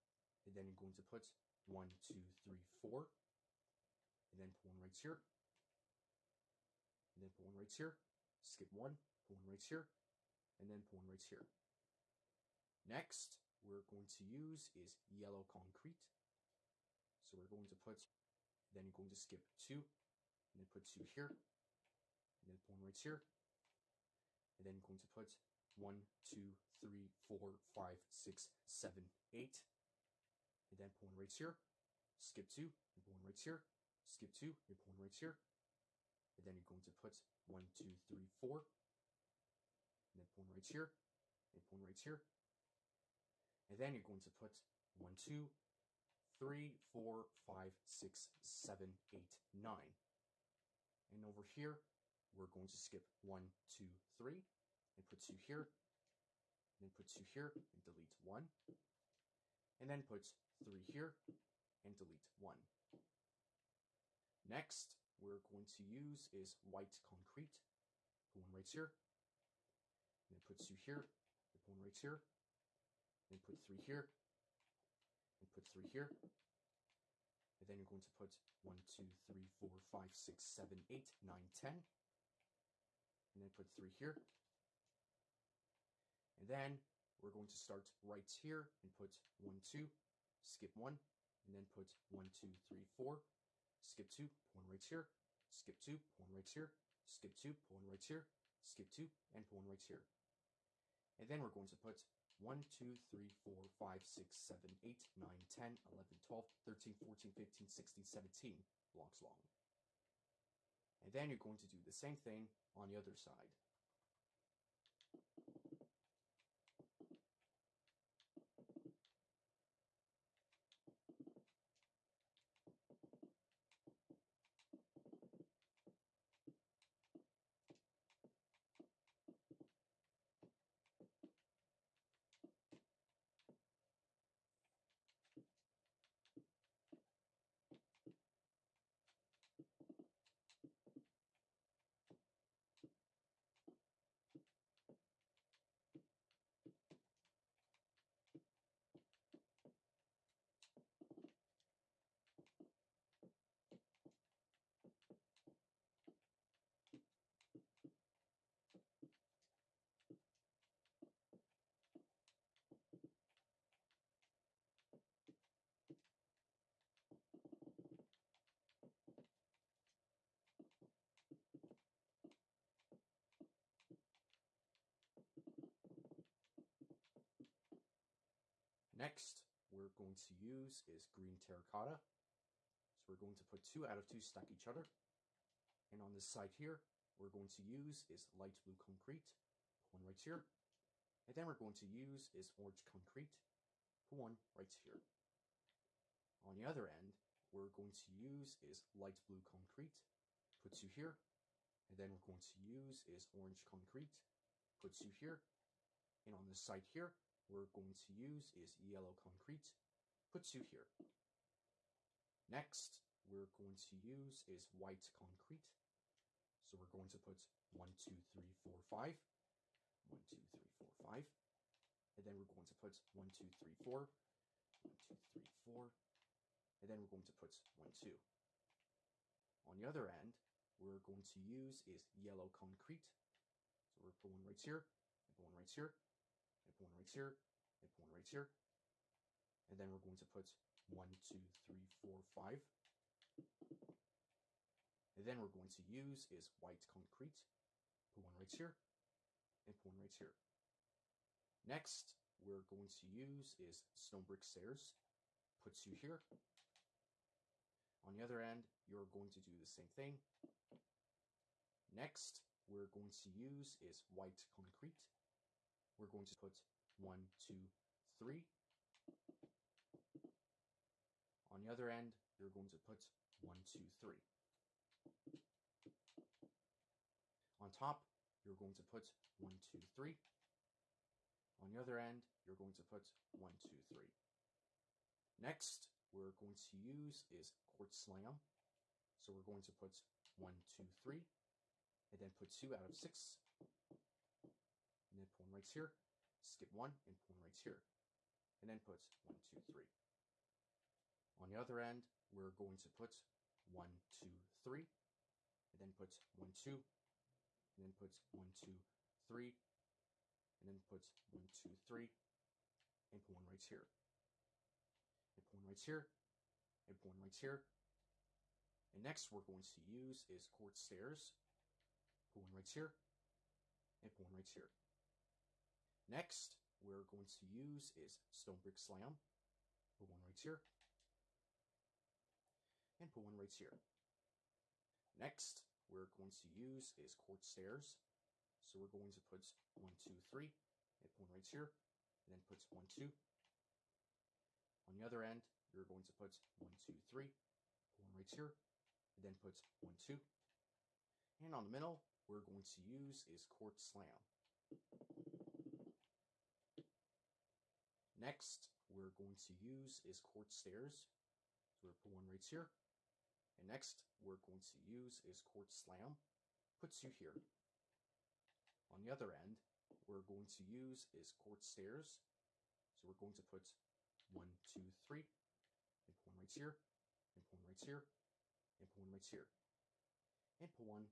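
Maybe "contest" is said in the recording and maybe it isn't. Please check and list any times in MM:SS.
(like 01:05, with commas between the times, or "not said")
not said.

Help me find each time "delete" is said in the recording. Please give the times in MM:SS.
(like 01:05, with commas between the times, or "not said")
00:57, 01:01.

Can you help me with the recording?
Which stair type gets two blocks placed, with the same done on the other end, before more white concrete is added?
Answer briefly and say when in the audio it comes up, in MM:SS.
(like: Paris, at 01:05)
Stone brick stairs, at 04:13.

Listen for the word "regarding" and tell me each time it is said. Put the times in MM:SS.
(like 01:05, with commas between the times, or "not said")
not said.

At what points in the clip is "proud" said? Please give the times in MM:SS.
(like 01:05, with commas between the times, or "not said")
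not said.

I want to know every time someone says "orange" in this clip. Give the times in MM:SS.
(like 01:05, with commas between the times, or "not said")
03:12, 03:23.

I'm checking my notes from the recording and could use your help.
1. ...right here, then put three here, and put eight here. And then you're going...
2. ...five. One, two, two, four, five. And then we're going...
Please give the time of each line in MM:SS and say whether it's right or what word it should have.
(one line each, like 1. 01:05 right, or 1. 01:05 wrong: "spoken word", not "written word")
1. 01:11 wrong: "three", not "eight"
2. 03:38 wrong: "three", not "two".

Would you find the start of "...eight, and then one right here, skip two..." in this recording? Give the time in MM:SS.
00:29.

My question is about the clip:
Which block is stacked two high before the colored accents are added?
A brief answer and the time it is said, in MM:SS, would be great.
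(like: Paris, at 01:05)
Green terracotta, at 03:01.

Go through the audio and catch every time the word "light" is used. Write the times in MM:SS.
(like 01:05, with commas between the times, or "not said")
03:08, 03:18.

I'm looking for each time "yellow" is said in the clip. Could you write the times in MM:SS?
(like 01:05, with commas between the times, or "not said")
00:15, 03:28, 03:52.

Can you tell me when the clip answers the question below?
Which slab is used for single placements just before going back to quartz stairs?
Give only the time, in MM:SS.
05:28.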